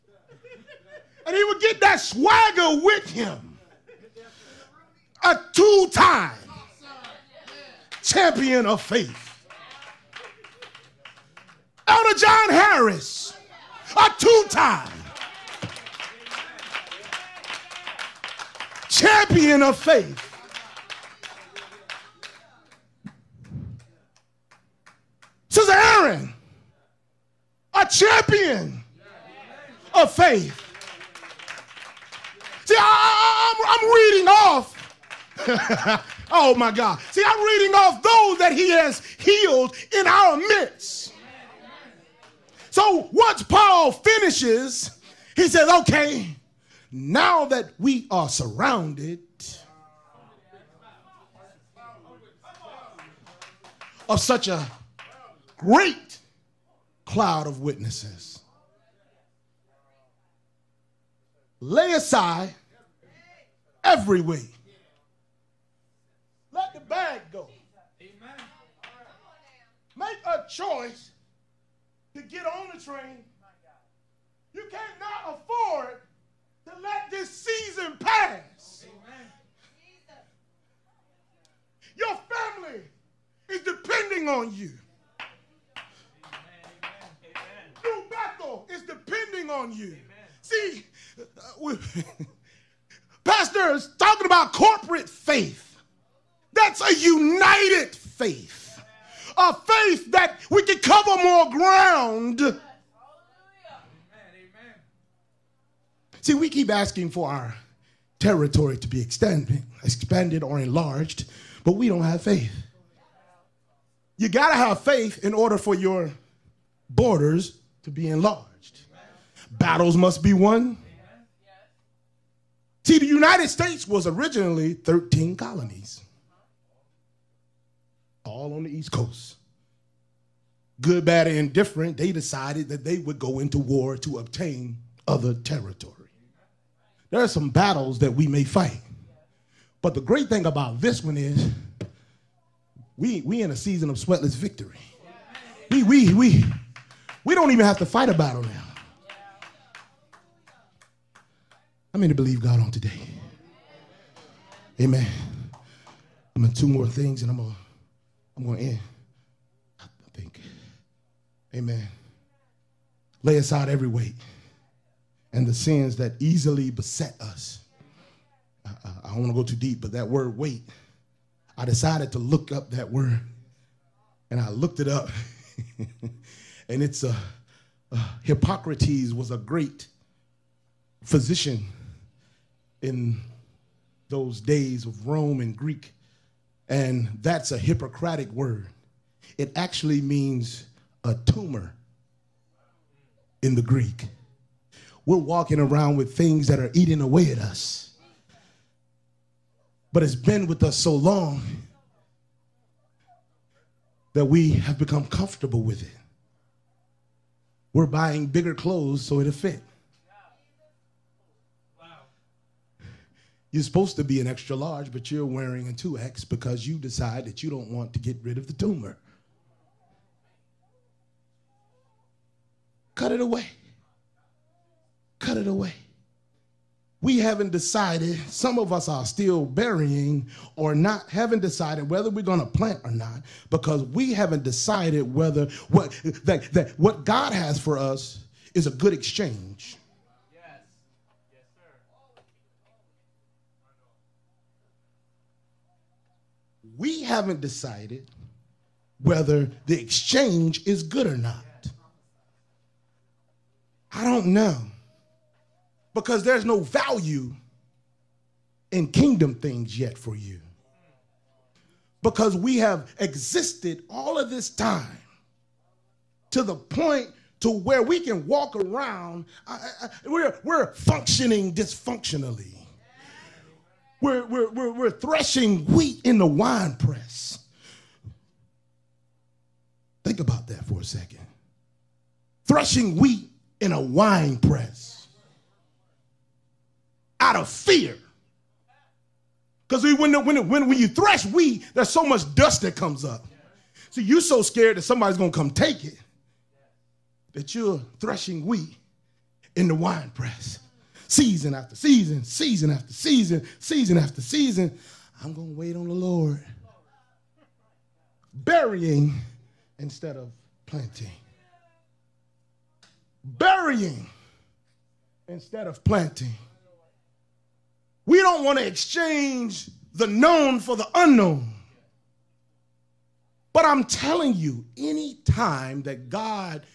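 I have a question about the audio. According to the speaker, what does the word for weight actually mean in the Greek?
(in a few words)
a tumor.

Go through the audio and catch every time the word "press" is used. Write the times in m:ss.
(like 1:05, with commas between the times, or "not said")
4:36, 4:44, 5:00.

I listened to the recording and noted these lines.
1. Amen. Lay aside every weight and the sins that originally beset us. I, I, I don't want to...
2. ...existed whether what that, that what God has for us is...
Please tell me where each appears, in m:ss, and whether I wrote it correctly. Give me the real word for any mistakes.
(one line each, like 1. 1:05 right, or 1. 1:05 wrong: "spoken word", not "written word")
1. 2:41 wrong: "easily", not "originally"
2. 3:54 wrong: "decided", not "existed".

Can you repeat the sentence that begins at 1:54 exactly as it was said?
You got to have faith in order for your borders to be enlarged.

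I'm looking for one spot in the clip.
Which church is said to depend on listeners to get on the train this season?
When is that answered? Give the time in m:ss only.
1:27.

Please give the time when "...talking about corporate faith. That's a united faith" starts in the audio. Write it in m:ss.
1:33.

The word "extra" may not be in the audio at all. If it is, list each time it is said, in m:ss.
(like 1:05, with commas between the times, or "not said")
3:34.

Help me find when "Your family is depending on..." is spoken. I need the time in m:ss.
1:21.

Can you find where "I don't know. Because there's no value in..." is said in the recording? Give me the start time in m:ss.
4:13.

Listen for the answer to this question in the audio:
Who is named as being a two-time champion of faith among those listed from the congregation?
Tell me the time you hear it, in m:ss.
0:11.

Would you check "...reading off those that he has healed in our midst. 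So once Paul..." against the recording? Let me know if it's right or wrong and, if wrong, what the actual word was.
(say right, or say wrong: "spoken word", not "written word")
right.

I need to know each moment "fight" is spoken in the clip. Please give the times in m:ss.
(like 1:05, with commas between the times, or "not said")
2:18, 2:27.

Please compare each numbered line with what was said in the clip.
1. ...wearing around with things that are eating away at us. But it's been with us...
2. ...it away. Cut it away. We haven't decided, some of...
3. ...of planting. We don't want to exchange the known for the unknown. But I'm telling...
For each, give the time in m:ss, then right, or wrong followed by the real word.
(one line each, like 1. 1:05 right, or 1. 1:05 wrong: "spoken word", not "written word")
1. 3:15 wrong: "walking", not "wearing"
2. 3:43 right
3. 5:15 right.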